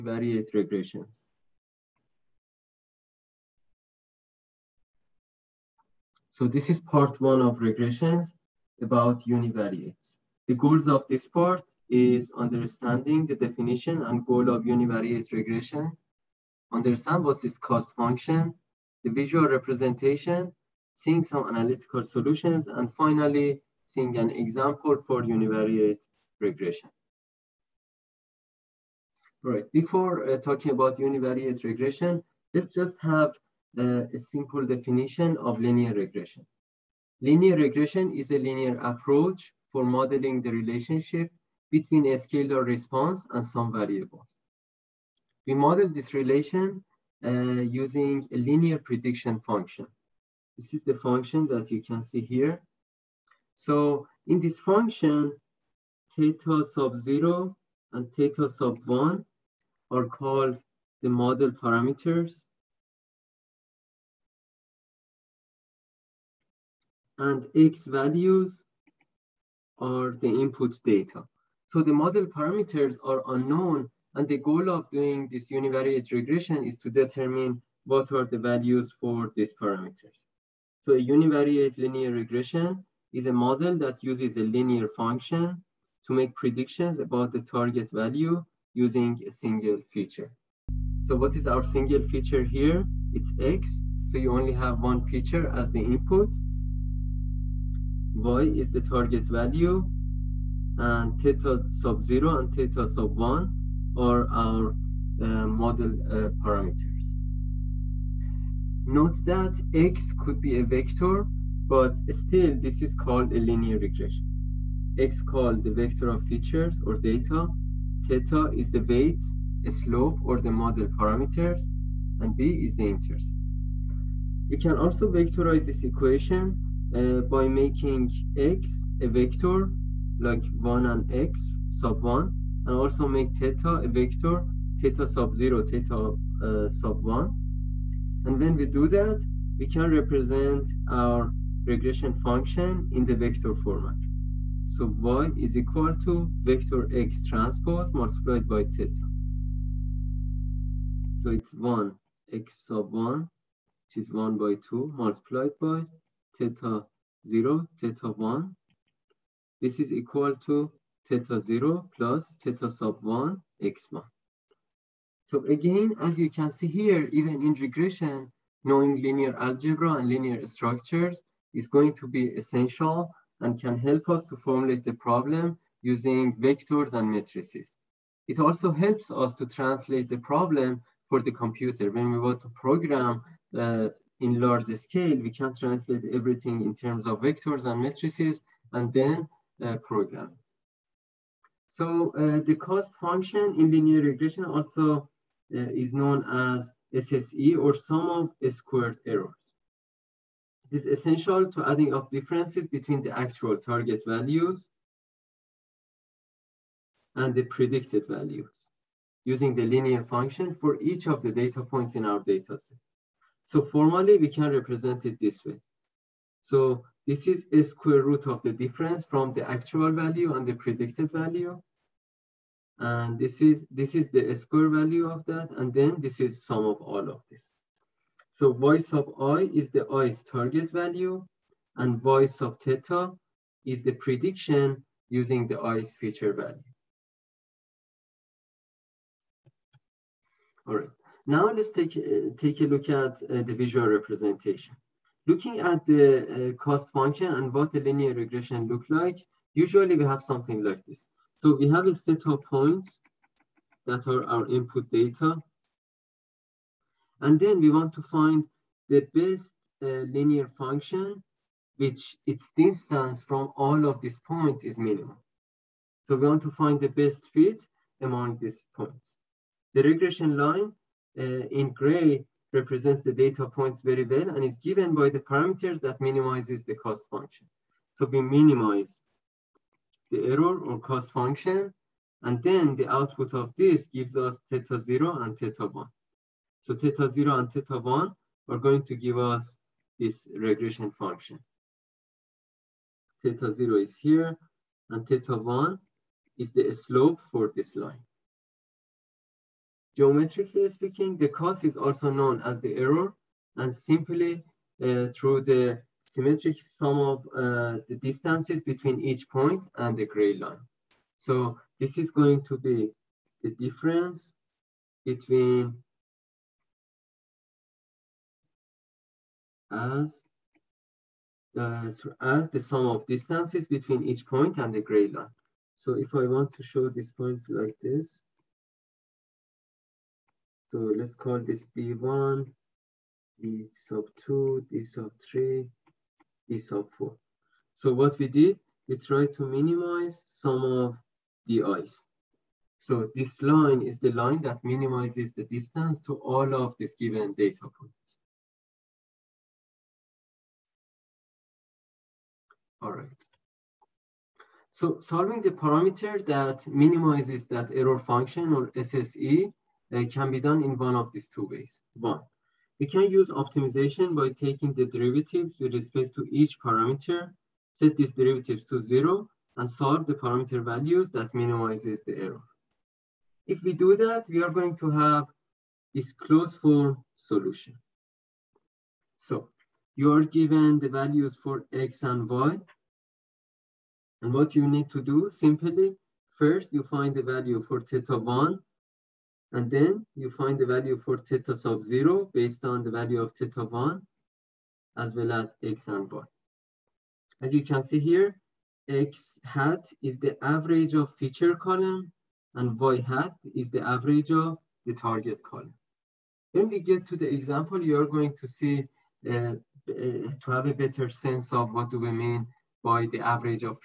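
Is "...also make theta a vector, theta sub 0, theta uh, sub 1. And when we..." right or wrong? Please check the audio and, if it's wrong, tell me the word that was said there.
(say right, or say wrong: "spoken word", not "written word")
right.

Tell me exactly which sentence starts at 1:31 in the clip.
So what is our single feature here?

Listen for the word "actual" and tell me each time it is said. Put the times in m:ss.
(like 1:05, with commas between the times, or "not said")
3:23, 3:39.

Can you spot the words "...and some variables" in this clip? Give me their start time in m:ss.
0:43.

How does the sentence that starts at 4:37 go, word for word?
So we minimize the error or cost function, and then the output of this gives us theta zero and theta one.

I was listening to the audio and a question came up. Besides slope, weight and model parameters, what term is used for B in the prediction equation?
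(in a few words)
intercept.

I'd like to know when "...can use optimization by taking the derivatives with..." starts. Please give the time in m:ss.
6:02.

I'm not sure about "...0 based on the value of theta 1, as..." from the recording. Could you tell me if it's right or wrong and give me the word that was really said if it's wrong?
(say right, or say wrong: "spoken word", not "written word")
right.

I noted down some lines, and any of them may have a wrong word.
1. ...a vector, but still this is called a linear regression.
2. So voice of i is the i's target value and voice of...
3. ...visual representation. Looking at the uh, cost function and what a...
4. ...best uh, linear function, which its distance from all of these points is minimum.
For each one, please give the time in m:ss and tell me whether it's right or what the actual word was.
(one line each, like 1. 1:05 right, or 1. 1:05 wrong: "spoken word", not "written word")
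1. 1:50 right
2. 3:48 right
3. 4:03 right
4. 4:19 right.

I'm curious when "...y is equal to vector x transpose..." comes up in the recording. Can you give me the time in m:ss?
2:24.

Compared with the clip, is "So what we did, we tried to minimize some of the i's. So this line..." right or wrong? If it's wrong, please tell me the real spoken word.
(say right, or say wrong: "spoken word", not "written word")
right.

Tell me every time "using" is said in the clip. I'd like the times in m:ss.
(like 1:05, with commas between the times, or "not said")
0:47, 1:28, 2:55, 3:29, 3:55.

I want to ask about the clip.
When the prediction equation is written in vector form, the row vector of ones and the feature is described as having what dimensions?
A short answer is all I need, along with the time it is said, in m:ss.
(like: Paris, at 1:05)
1 by 2, at 2:34.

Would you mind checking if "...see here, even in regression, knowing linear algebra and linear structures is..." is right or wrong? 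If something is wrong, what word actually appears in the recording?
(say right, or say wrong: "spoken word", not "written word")
right.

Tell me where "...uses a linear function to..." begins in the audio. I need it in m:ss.
1:24.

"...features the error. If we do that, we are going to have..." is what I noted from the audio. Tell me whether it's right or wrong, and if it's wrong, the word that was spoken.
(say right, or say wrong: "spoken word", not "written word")
wrong: "minimizes", not "features".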